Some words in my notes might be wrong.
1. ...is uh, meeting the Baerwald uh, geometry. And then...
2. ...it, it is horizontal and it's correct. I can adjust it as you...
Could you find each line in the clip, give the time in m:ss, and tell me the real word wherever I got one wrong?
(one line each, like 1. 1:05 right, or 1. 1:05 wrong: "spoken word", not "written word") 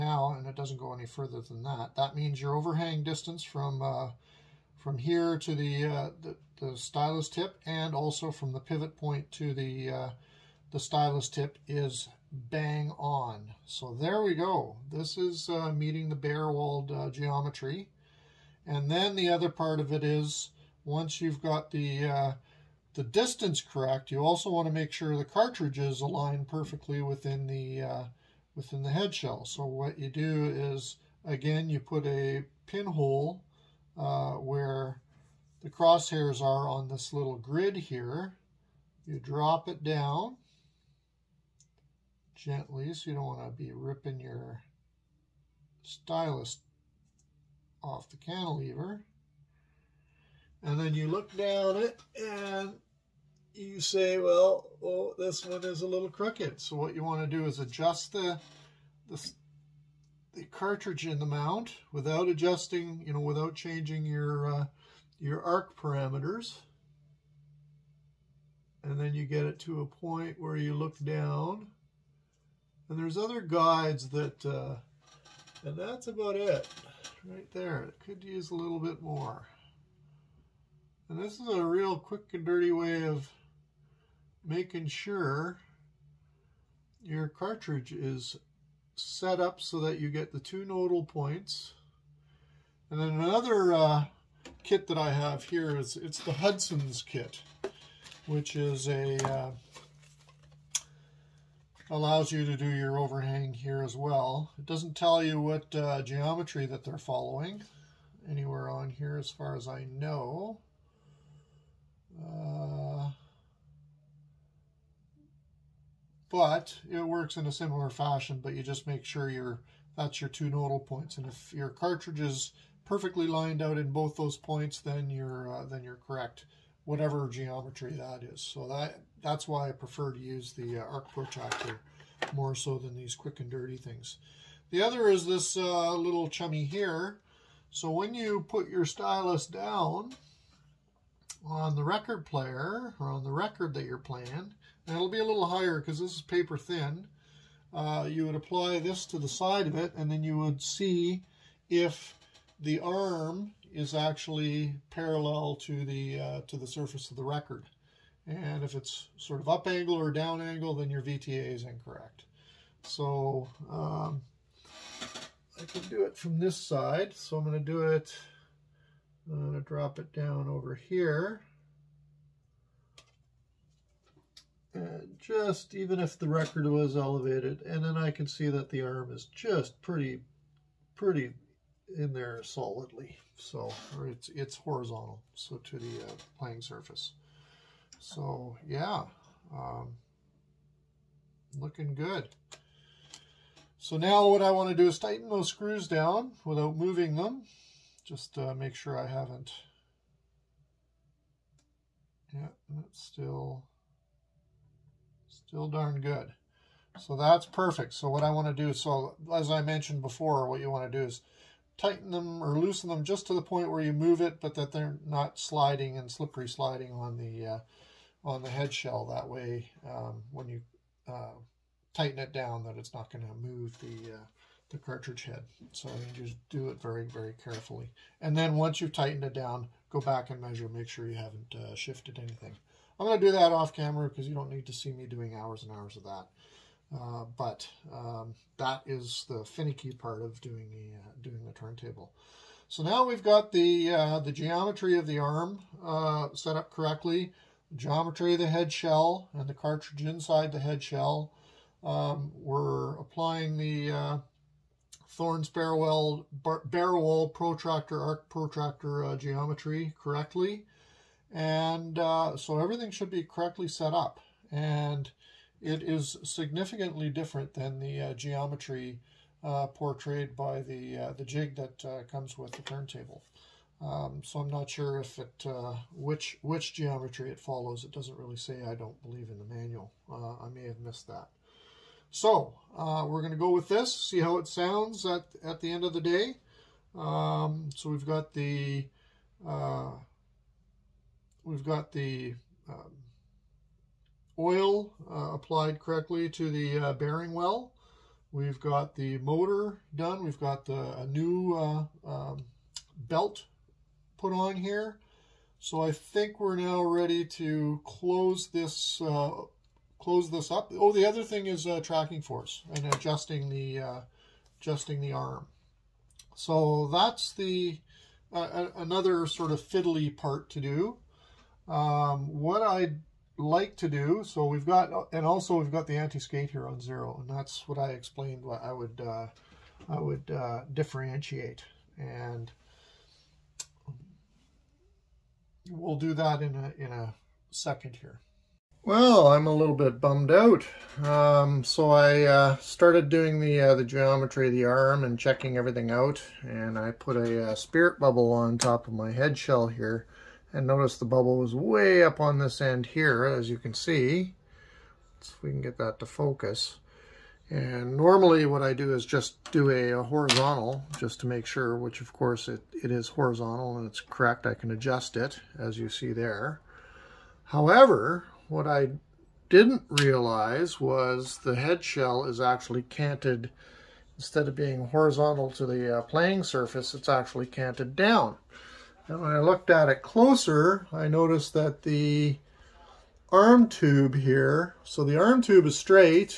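1. 0:15 right
2. 6:02 right.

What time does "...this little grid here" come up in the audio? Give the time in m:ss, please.
0:36.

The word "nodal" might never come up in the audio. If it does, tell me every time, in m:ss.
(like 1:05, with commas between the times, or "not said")
1:30, 2:00.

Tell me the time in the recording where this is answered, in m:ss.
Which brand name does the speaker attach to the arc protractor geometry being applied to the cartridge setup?
4:15.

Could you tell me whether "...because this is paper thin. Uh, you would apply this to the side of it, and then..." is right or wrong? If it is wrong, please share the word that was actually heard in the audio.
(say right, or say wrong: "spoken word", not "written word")
right.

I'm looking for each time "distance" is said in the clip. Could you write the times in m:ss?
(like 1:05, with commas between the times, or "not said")
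0:03, 0:23.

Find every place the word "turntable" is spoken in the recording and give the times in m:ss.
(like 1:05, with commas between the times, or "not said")
4:01, 4:32.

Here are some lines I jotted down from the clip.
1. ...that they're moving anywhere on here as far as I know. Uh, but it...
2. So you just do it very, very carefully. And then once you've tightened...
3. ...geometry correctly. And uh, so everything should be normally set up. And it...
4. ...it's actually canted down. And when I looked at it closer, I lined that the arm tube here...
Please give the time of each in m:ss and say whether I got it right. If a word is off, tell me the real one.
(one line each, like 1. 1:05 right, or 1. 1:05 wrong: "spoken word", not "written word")
1. 1:46 wrong: "following", not "moving"
2. 3:45 right
3. 4:19 wrong: "correctly", not "normally"
4. 6:16 wrong: "noticed", not "lined".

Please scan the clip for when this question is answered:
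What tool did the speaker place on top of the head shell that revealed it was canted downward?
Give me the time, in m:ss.
5:47.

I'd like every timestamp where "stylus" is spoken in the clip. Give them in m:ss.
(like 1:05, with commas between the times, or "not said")
0:06, 0:10, 0:45, 2:18.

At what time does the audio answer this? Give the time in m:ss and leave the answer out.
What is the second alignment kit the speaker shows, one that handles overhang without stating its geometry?
1:36.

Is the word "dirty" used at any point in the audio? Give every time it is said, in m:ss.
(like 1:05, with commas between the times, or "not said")
1:22, 2:13.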